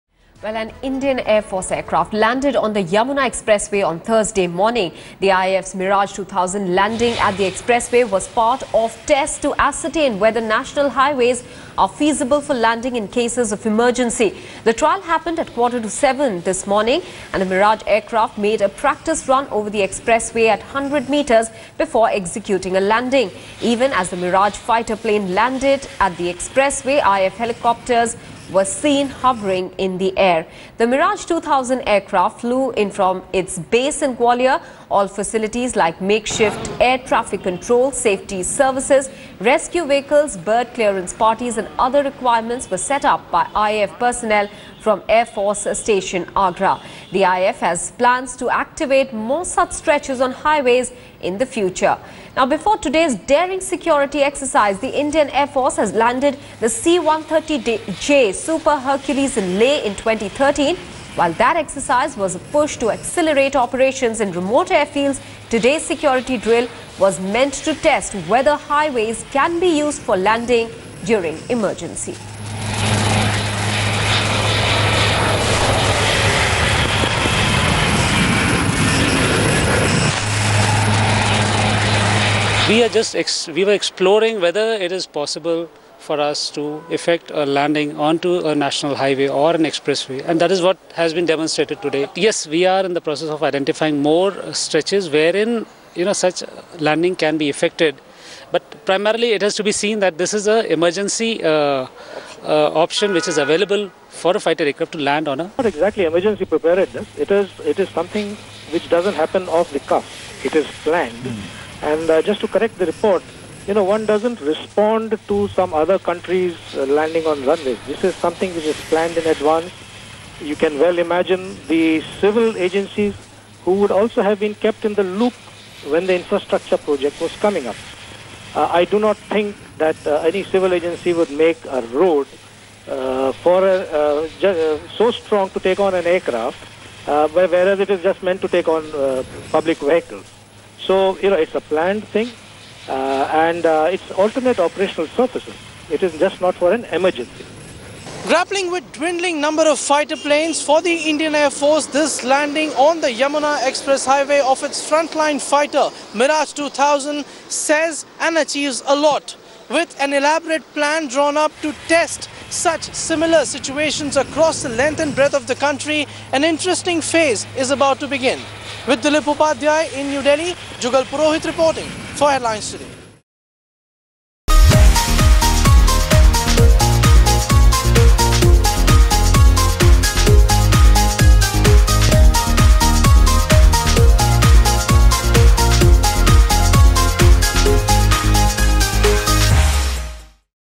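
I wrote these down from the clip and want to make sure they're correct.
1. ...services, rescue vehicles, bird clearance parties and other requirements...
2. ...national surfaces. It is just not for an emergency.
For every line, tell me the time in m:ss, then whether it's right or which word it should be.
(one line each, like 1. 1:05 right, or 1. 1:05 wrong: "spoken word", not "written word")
1. 0:38 right
2. 2:24 wrong: "operational", not "national".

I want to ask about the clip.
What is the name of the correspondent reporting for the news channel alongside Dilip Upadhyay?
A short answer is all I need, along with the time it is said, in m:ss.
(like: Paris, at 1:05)
Jugal Purohit, at 2:50.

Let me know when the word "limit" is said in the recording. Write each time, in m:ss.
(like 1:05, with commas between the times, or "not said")
not said.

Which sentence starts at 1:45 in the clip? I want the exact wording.
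Not exactly emergency preparedness, it is, it is something which doesn't happen off the cuff, it is planned.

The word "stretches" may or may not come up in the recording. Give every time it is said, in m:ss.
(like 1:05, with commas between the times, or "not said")
0:49, 1:34.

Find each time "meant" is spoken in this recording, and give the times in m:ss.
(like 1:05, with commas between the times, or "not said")
1:07, 2:18.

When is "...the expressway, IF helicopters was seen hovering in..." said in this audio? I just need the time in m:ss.
0:26.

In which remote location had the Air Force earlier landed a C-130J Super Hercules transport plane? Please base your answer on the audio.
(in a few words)
Leh.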